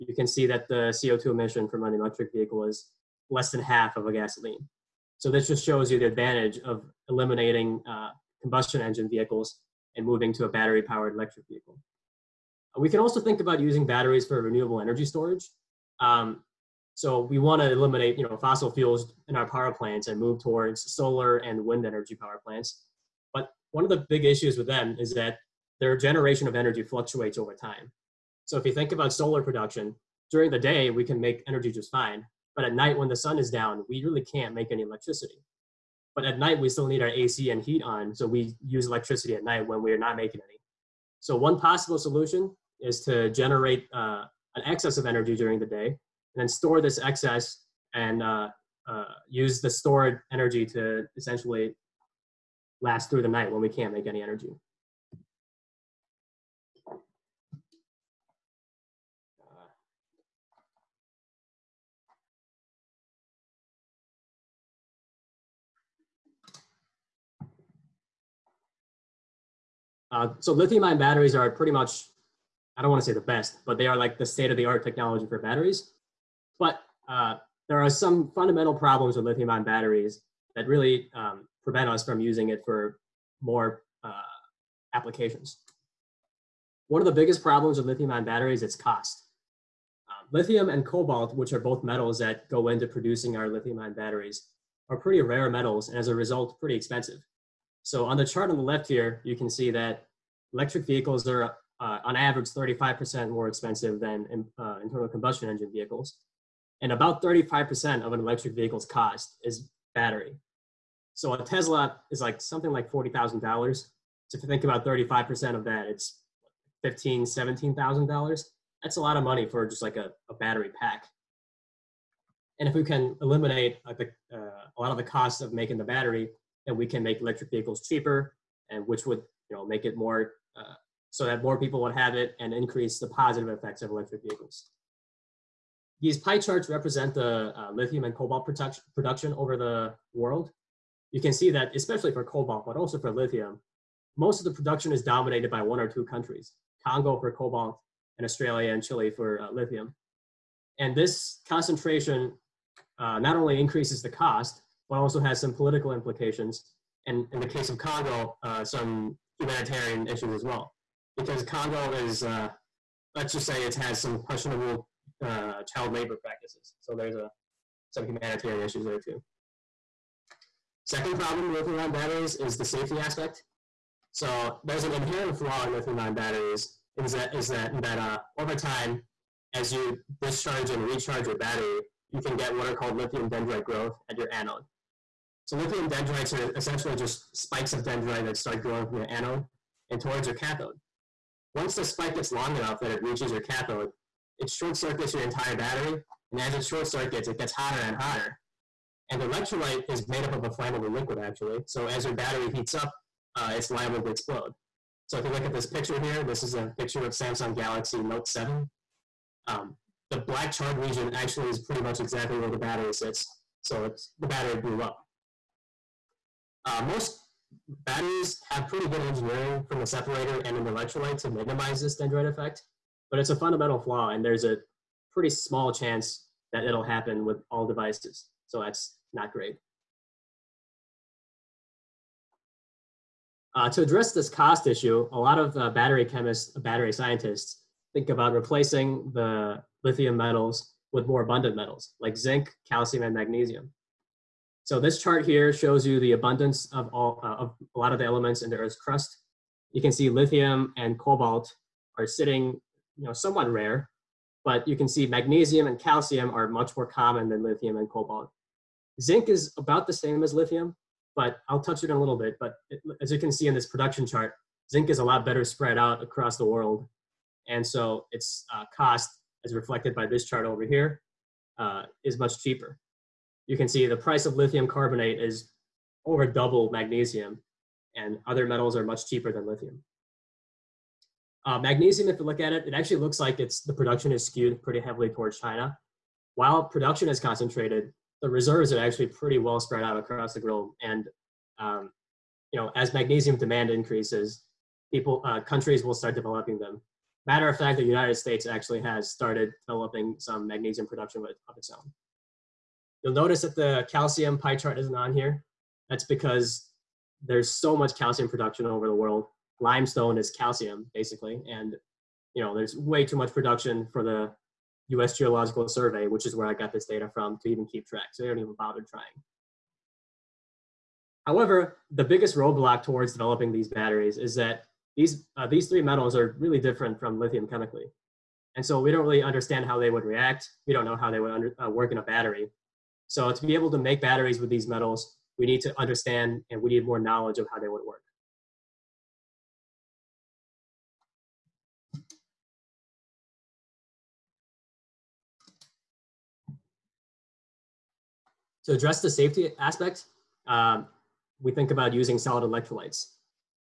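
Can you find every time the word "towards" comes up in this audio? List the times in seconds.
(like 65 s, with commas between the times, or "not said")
20 s, 190 s, 285 s, 322 s.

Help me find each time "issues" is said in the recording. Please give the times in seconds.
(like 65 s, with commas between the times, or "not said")
24 s, 160 s, 168 s, 234 s.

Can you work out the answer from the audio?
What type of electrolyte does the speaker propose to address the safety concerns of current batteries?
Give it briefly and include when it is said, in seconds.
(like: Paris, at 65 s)
Solid electrolytes, at 352 s.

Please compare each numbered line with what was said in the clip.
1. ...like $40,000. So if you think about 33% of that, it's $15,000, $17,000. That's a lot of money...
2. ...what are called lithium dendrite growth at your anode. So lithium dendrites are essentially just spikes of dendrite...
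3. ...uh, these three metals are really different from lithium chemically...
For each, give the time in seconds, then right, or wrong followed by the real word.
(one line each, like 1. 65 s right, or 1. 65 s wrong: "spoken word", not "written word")
1. 112 s wrong: "35", not "33"
2. 182 s right
3. 325 s right.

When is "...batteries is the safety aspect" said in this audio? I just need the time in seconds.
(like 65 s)
171 s.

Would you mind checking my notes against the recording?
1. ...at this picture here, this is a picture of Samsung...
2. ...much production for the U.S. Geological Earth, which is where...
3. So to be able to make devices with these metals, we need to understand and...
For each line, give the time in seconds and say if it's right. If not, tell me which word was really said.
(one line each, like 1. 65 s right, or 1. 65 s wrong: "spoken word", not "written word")
1. 205 s right
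2. 313 s wrong: "Survey", not "Earth"
3. 333 s wrong: "batteries", not "devices".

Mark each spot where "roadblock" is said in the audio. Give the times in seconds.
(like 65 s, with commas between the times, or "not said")
322 s.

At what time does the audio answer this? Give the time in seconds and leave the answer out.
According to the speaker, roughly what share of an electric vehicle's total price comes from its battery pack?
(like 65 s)
106 s.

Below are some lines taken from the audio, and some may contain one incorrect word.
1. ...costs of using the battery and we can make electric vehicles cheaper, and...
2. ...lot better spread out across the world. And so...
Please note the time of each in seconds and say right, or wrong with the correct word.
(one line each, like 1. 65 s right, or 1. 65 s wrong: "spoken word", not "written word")
1. 125 s wrong: "making", not "using"
2. 265 s right.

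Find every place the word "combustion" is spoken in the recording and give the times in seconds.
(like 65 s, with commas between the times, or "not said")
8 s, 105 s.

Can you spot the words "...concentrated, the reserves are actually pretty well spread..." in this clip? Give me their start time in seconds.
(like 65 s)
287 s.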